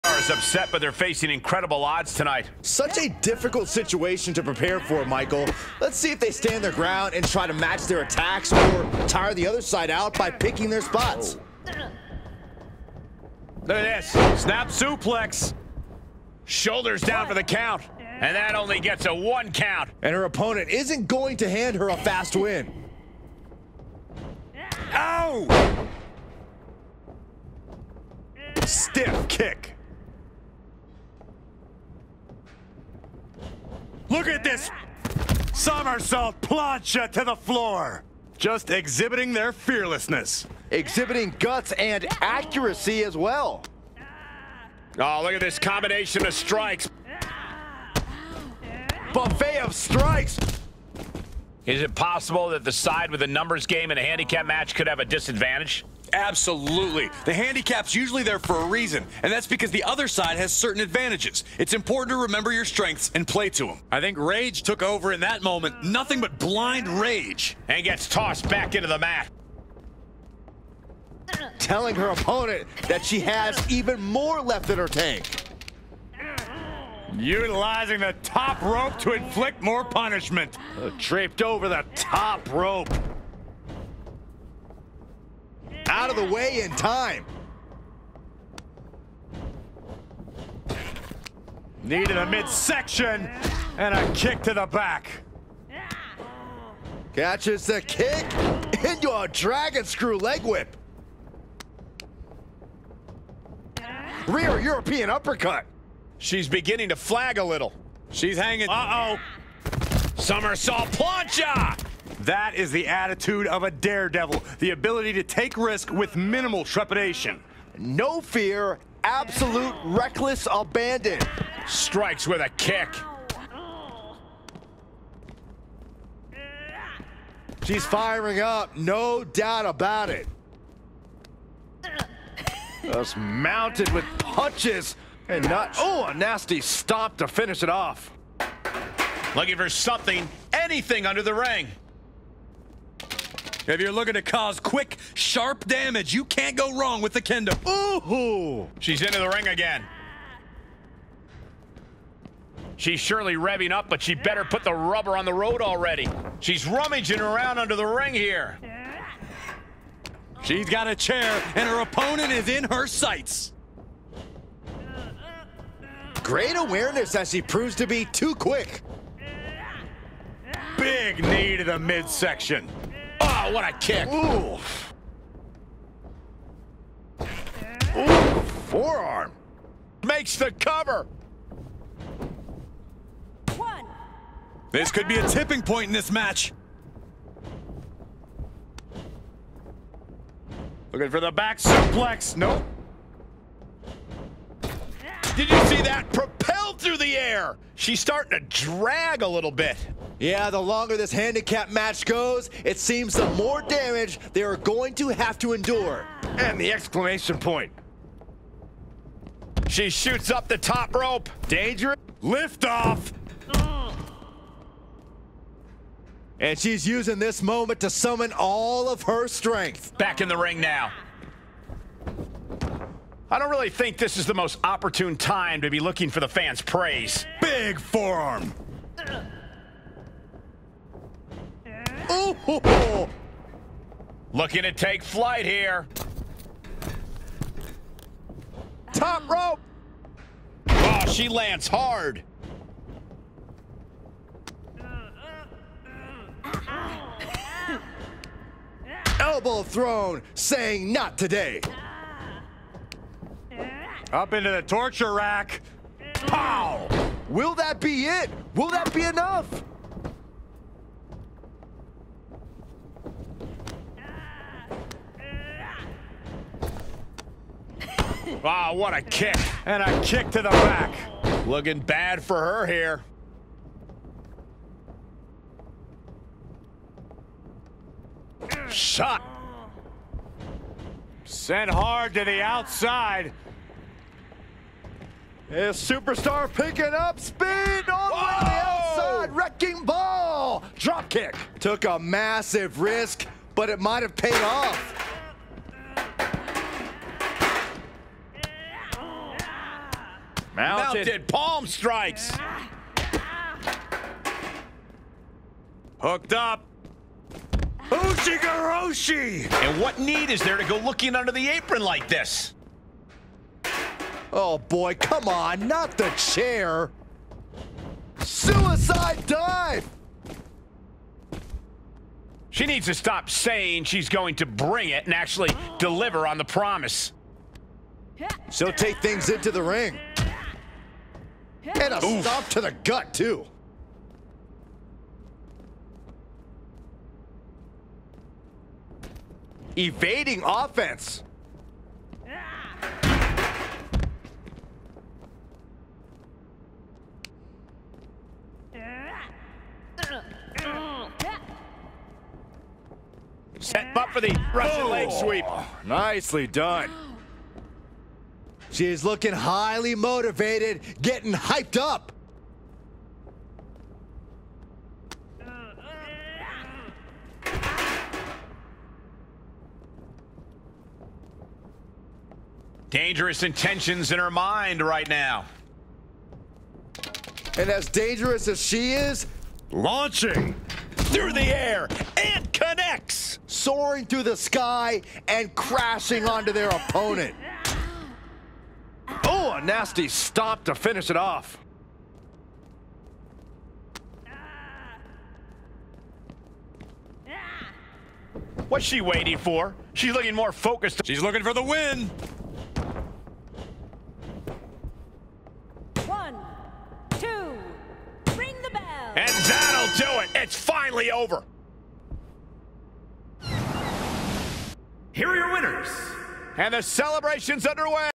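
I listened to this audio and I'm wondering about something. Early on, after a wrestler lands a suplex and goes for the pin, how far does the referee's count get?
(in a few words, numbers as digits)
1.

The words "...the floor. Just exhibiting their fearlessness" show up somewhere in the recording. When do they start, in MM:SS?
00:37.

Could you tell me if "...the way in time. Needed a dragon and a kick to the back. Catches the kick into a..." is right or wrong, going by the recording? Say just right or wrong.
wrong.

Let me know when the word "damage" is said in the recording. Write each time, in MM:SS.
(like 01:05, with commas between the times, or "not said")
02:25, 03:23.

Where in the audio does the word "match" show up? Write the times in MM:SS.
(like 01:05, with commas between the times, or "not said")
00:07, 00:54, 03:06, 03:21.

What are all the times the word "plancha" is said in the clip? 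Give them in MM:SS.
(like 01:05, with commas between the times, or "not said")
00:36, 01:50.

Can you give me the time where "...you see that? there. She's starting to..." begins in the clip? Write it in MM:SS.
03:15.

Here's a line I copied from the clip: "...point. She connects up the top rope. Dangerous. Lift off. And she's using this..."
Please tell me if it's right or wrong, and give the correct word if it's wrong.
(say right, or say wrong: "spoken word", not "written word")
wrong: "shoots", not "connects".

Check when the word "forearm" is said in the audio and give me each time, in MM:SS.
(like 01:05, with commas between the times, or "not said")
02:58, 03:47.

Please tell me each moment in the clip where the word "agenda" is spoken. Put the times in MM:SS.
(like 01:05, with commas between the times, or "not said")
not said.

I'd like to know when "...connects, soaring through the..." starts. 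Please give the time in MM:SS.
06:22.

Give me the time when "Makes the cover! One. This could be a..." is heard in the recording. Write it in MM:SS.
03:00.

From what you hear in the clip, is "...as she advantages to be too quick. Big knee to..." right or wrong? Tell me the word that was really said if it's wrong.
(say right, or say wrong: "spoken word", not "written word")
wrong: "proves", not "advantages".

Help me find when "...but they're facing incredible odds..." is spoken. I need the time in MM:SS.
00:00.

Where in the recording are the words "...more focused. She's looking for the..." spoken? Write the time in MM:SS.
06:40.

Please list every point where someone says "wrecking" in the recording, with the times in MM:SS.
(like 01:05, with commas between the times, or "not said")
04:49.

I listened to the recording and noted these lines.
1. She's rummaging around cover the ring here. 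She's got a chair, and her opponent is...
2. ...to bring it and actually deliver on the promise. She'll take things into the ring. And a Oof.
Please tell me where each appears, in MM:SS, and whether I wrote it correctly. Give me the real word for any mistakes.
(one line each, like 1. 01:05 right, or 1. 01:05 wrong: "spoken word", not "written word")
1. 02:36 wrong: "under", not "cover"
2. 05:24 right.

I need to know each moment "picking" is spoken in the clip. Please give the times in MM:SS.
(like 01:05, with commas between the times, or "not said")
00:10, 04:46.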